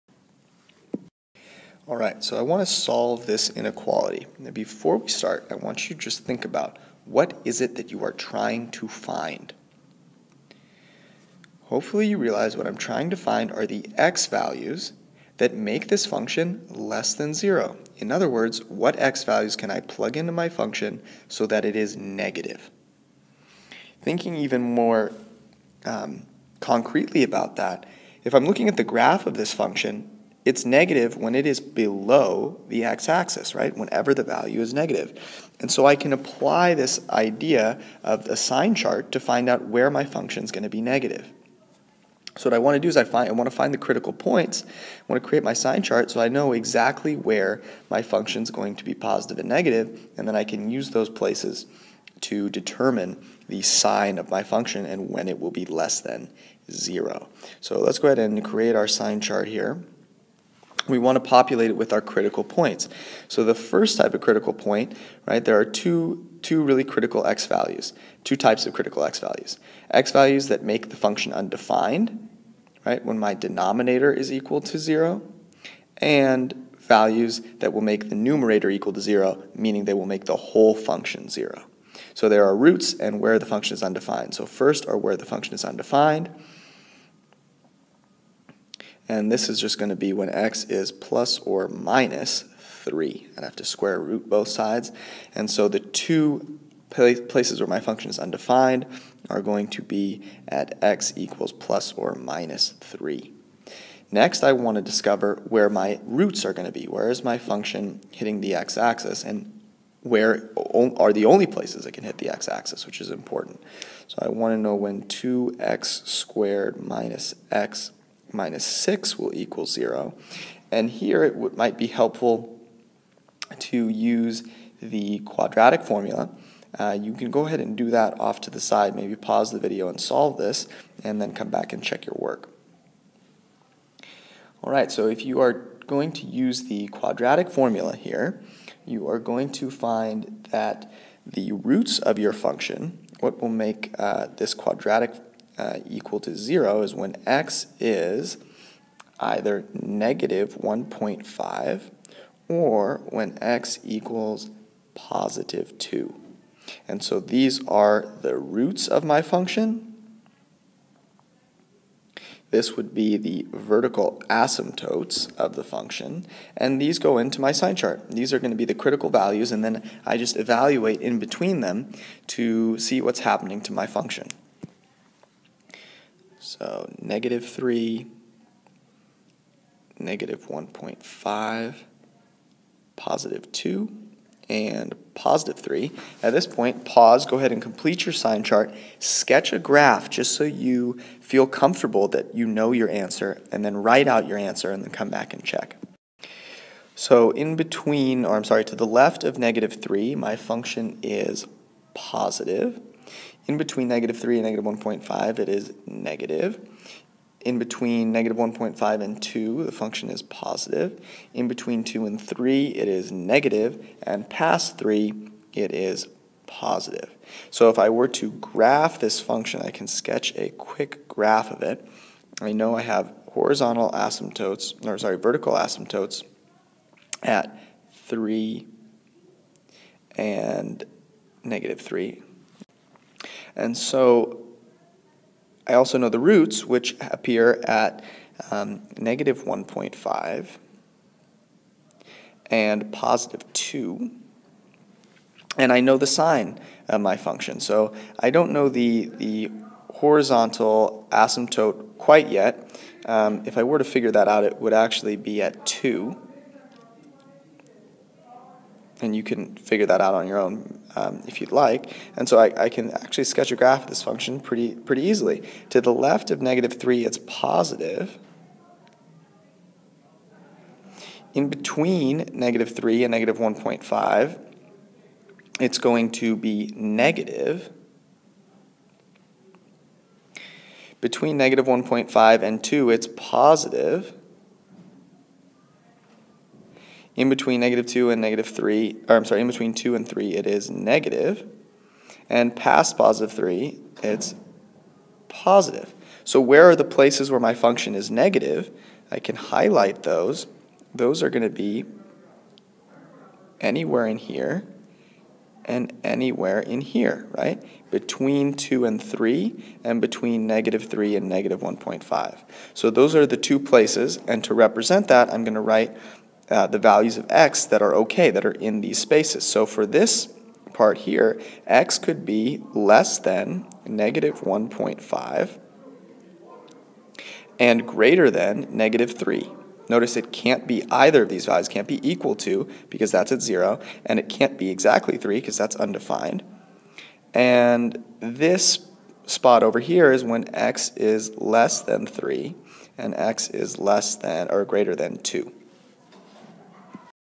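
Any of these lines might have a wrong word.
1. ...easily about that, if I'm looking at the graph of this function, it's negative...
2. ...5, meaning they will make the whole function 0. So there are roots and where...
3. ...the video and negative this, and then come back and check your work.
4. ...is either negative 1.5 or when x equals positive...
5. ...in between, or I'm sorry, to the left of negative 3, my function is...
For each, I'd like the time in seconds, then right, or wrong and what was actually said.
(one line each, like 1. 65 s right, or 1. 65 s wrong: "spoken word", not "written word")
1. 26 s wrong: "concretely", not "easily"
2. 79 s wrong: "0", not "5"
3. 129 s wrong: "solve", not "negative"
4. 147 s right
5. 197 s right.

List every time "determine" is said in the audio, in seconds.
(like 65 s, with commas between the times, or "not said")
52 s.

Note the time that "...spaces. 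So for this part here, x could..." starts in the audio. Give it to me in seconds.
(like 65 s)
318 s.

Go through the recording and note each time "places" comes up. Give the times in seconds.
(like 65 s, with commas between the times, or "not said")
51 s, 96 s, 111 s, 296 s, 313 s.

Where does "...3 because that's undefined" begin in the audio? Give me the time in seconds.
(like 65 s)
335 s.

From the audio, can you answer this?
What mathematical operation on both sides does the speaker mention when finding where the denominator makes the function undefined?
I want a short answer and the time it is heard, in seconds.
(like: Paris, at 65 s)
square root, at 93 s.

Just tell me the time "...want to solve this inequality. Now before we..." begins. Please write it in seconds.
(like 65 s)
2 s.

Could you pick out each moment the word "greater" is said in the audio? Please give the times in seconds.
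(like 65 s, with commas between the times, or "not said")
327 s, 344 s.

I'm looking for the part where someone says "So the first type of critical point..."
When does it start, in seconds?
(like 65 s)
63 s.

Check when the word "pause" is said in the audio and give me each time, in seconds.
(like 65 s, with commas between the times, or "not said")
129 s, 186 s.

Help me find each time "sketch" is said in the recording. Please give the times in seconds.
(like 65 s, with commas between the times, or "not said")
188 s, 219 s, 263 s.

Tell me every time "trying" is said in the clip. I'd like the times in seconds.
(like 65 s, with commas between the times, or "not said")
8 s, 12 s.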